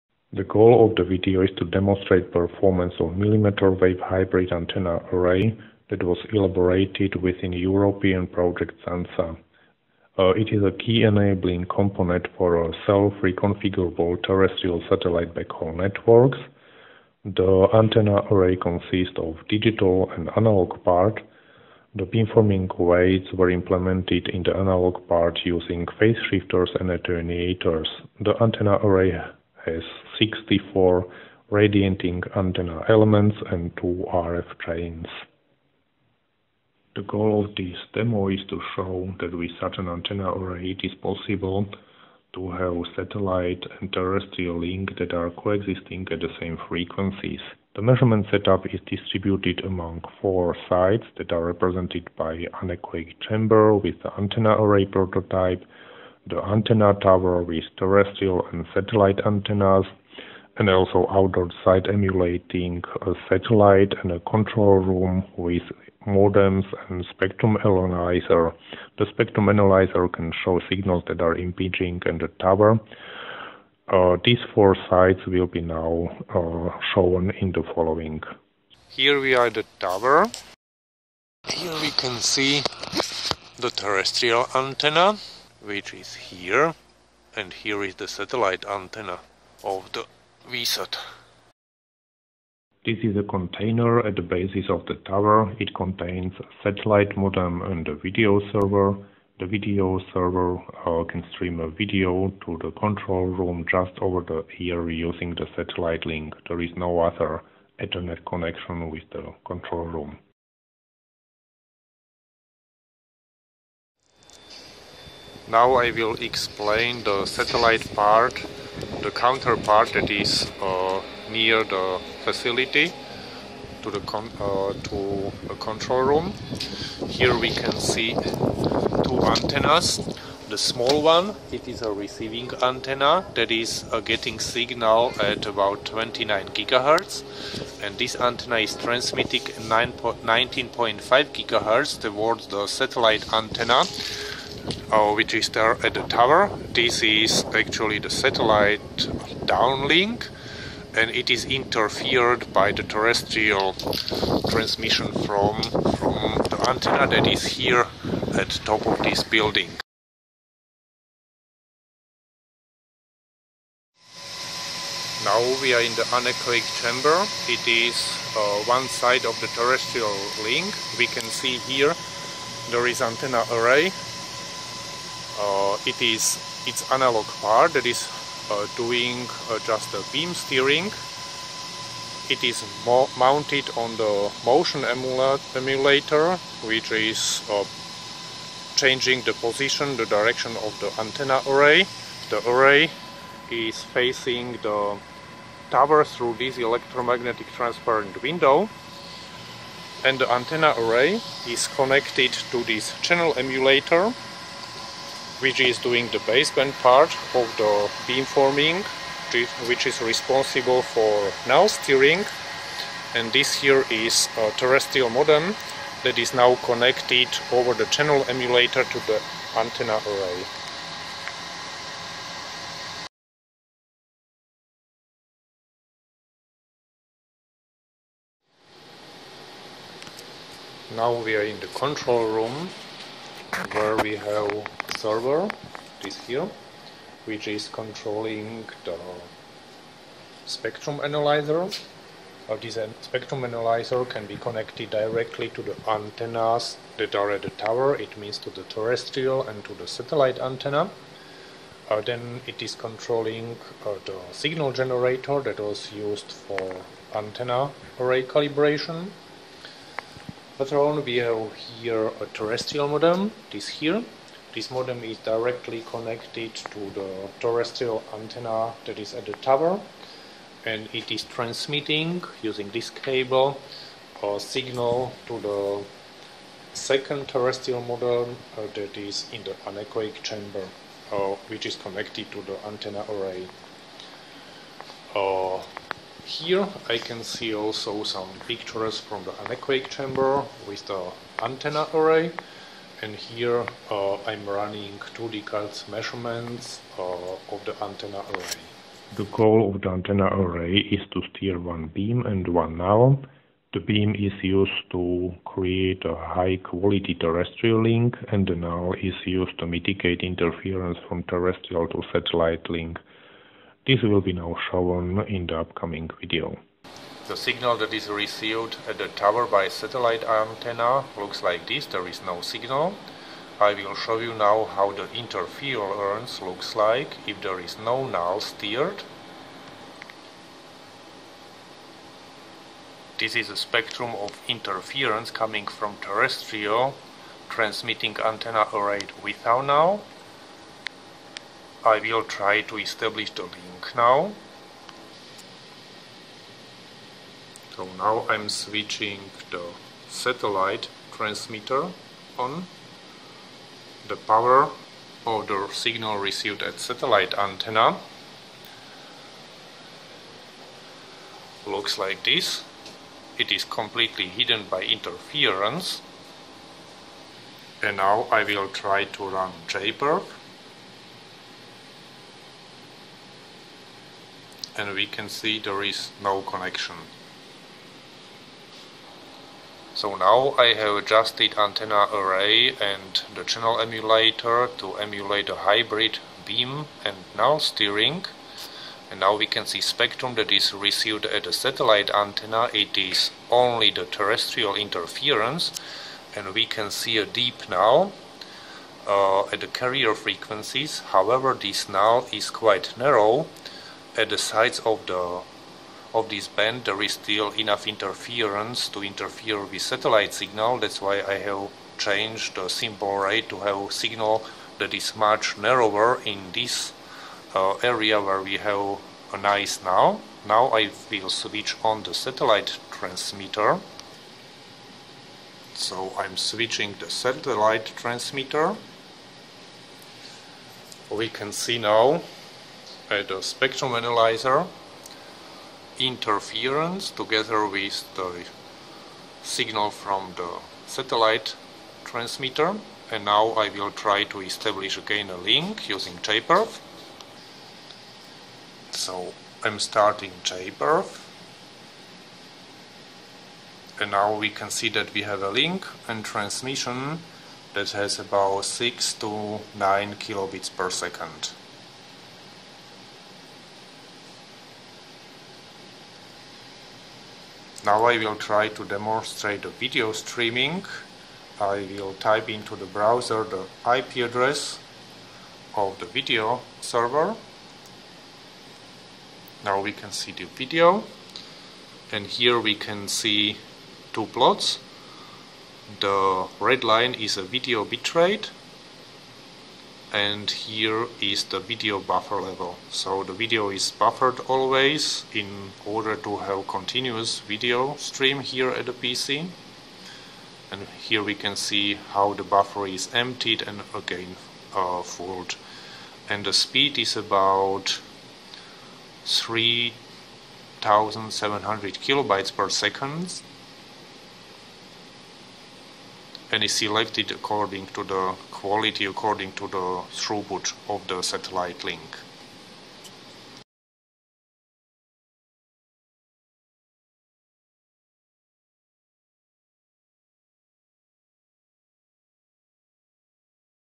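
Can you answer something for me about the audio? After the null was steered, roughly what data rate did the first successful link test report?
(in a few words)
6 to 9 kilobits per second.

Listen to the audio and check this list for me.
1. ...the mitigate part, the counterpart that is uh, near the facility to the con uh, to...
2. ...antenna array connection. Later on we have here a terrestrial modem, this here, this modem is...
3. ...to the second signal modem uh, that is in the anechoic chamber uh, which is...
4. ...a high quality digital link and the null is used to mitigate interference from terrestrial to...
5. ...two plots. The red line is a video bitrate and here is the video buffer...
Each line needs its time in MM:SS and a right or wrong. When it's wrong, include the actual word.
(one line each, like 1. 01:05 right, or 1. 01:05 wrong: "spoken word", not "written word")
1. 01:57 wrong: "satellite", not "mitigate"
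2. 04:17 wrong: "calibration", not "connection"
3. 04:35 wrong: "terrestrial", not "signal"
4. 05:06 wrong: "terrestrial", not "digital"
5. 08:04 right.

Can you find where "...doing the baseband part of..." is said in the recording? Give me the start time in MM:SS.
03:25.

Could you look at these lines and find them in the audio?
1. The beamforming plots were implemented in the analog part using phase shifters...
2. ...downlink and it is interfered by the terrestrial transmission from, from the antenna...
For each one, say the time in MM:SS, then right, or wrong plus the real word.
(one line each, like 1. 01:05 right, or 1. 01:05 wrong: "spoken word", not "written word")
1. 00:21 wrong: "weights", not "plots"
2. 02:29 right.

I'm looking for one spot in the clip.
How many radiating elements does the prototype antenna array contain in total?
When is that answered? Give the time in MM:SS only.
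00:30.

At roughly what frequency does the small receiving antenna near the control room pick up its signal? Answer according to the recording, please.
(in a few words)
29 GHz.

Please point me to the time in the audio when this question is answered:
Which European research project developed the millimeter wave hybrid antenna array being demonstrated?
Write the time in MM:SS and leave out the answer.
00:08.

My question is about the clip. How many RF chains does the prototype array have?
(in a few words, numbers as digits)
2.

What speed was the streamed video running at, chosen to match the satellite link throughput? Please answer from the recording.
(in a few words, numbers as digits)
3700 kilobytes per second.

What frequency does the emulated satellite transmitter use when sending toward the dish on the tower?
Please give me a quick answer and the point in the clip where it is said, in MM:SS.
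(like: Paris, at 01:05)
19.5 GHz, at 02:19.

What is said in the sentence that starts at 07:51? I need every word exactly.
I will type into the browser the IP address of the video server.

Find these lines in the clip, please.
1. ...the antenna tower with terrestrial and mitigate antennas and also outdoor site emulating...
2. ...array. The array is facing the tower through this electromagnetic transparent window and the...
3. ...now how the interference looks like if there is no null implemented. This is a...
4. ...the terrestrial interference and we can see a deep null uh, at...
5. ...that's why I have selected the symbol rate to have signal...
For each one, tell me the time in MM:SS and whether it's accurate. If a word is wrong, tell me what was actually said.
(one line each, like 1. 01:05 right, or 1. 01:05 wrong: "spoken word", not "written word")
1. 00:56 wrong: "satellite", not "mitigate"
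2. 03:11 right
3. 05:24 wrong: "steered", not "implemented"
4. 06:33 right
5. 06:50 wrong: "changed", not "selected".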